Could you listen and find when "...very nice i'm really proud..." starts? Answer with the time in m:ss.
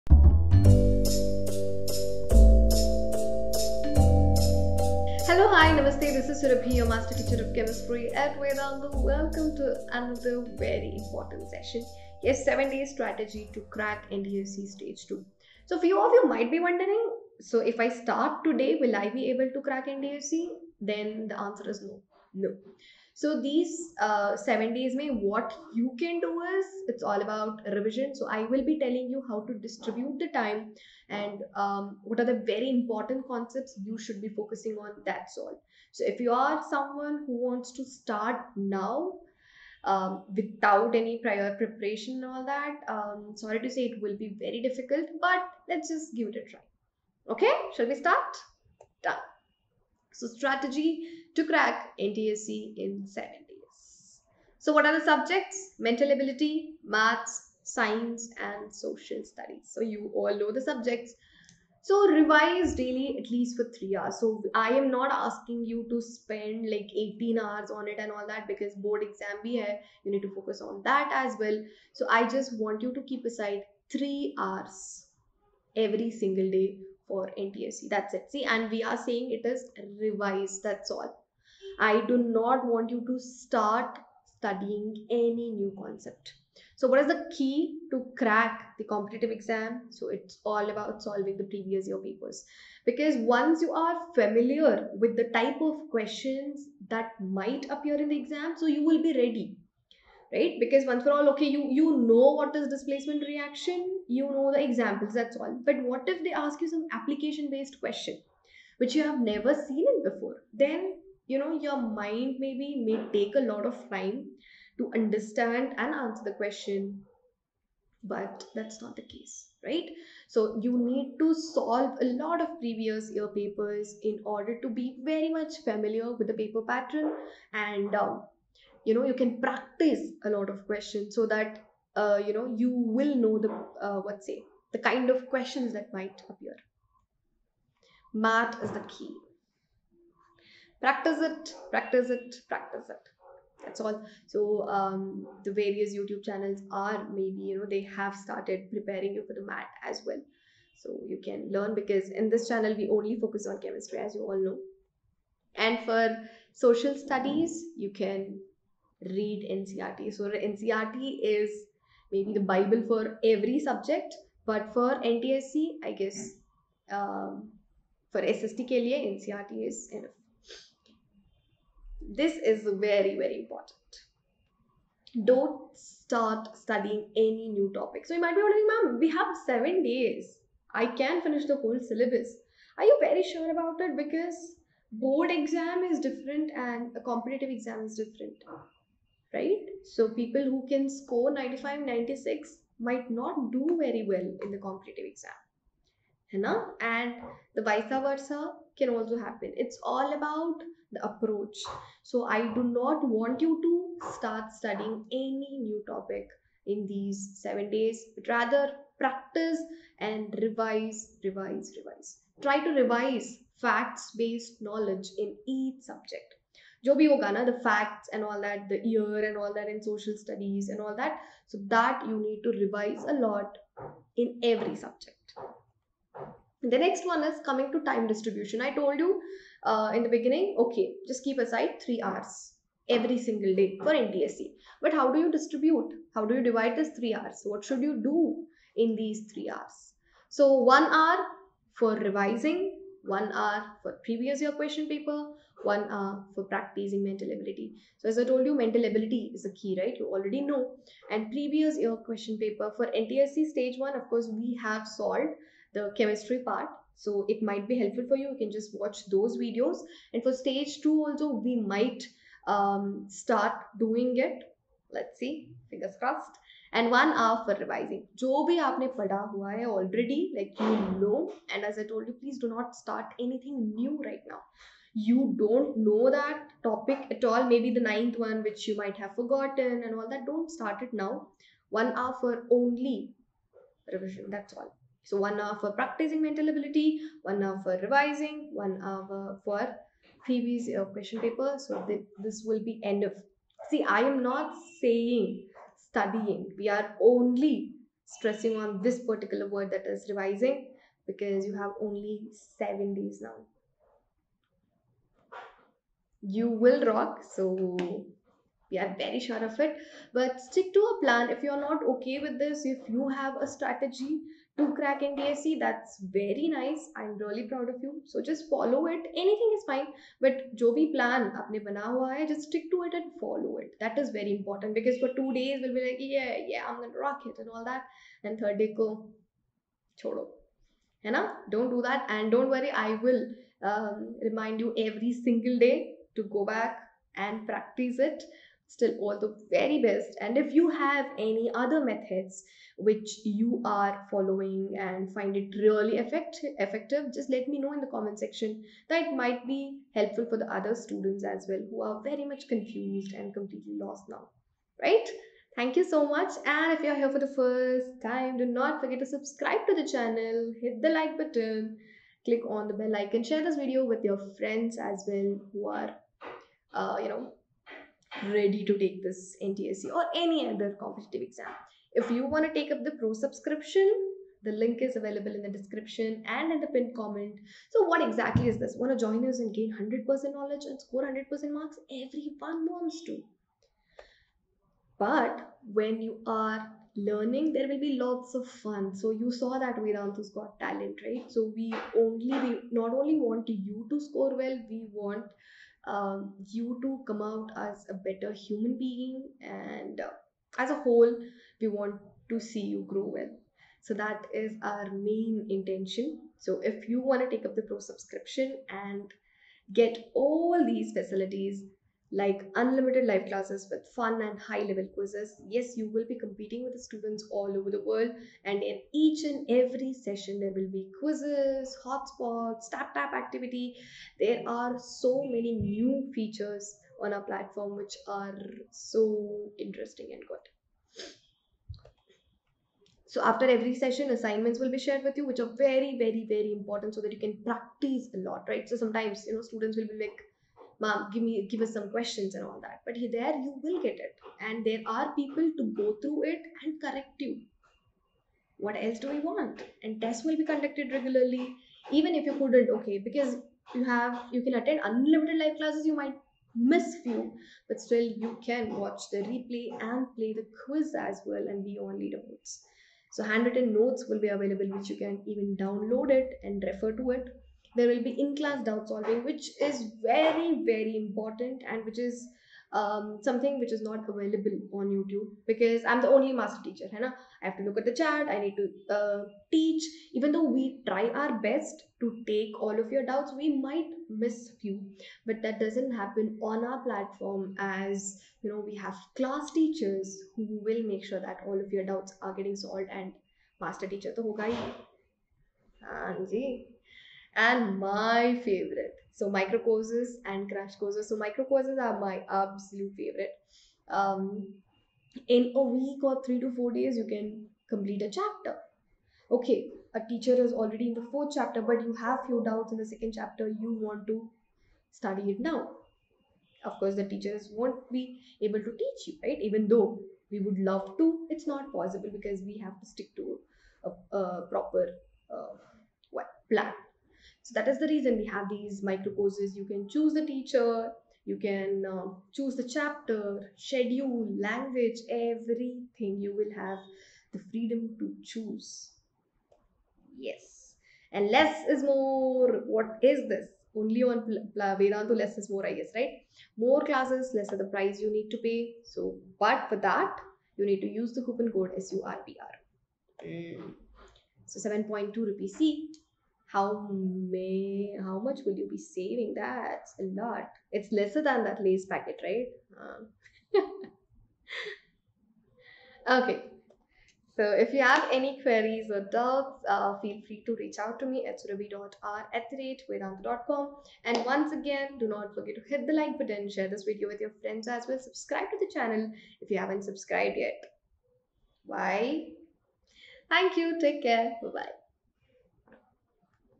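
5:16.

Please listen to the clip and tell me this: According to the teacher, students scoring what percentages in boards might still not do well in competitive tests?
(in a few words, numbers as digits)
95, 96.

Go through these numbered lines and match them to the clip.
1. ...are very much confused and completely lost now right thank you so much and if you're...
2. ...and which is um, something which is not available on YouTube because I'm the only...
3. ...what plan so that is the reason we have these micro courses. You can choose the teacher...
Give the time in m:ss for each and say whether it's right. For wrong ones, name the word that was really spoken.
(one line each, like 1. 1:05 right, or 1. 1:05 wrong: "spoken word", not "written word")
1. 5:51 right
2. 7:51 right
3. 8:46 right.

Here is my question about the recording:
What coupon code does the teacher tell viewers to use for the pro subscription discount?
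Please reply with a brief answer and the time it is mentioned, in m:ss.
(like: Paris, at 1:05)
SURPRO, at 9:11.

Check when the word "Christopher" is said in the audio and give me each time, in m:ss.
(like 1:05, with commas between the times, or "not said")
not said.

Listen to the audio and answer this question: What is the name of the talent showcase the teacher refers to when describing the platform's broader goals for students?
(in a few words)
Vedantu's got talent.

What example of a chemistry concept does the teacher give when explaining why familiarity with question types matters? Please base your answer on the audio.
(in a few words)
displacement reaction.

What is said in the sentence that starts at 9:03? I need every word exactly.
Only on Vedantu, less is more, I guess, right?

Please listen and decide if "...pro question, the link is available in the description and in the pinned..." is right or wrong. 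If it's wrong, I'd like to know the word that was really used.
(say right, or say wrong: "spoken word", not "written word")
wrong: "subscription", not "question".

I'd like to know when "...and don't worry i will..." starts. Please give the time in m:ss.
5:32.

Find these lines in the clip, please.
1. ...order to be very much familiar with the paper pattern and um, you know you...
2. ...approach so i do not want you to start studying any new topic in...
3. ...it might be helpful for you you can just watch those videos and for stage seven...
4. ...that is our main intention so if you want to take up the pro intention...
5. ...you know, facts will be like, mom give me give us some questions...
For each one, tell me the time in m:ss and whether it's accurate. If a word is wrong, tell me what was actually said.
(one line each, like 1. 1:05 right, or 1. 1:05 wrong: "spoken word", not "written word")
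1. 2:04 right
2. 3:21 right
3. 4:17 wrong: "two", not "seven"
4. 6:43 wrong: "subscription", not "intention"
5. 7:19 wrong: "students", not "facts".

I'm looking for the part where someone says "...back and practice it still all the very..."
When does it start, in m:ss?
5:36.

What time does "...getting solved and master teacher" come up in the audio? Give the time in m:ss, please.
8:12.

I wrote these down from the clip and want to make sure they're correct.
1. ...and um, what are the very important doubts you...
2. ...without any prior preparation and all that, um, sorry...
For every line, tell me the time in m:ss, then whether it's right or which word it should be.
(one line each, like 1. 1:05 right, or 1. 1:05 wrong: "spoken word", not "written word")
1. 0:31 wrong: "concepts", not "doubts"
2. 0:40 right.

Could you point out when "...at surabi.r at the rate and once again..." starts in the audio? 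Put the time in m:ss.
9:31.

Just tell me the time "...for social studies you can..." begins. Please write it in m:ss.
2:35.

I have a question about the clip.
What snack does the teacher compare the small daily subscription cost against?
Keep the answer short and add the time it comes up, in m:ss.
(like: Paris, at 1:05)
lace packet, at 9:21.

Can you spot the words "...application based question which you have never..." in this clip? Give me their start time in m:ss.
1:46.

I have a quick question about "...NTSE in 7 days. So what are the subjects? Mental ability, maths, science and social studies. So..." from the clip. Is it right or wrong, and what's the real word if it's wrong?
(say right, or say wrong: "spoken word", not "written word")
right.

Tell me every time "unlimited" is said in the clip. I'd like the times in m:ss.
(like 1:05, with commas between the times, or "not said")
6:52, 7:34.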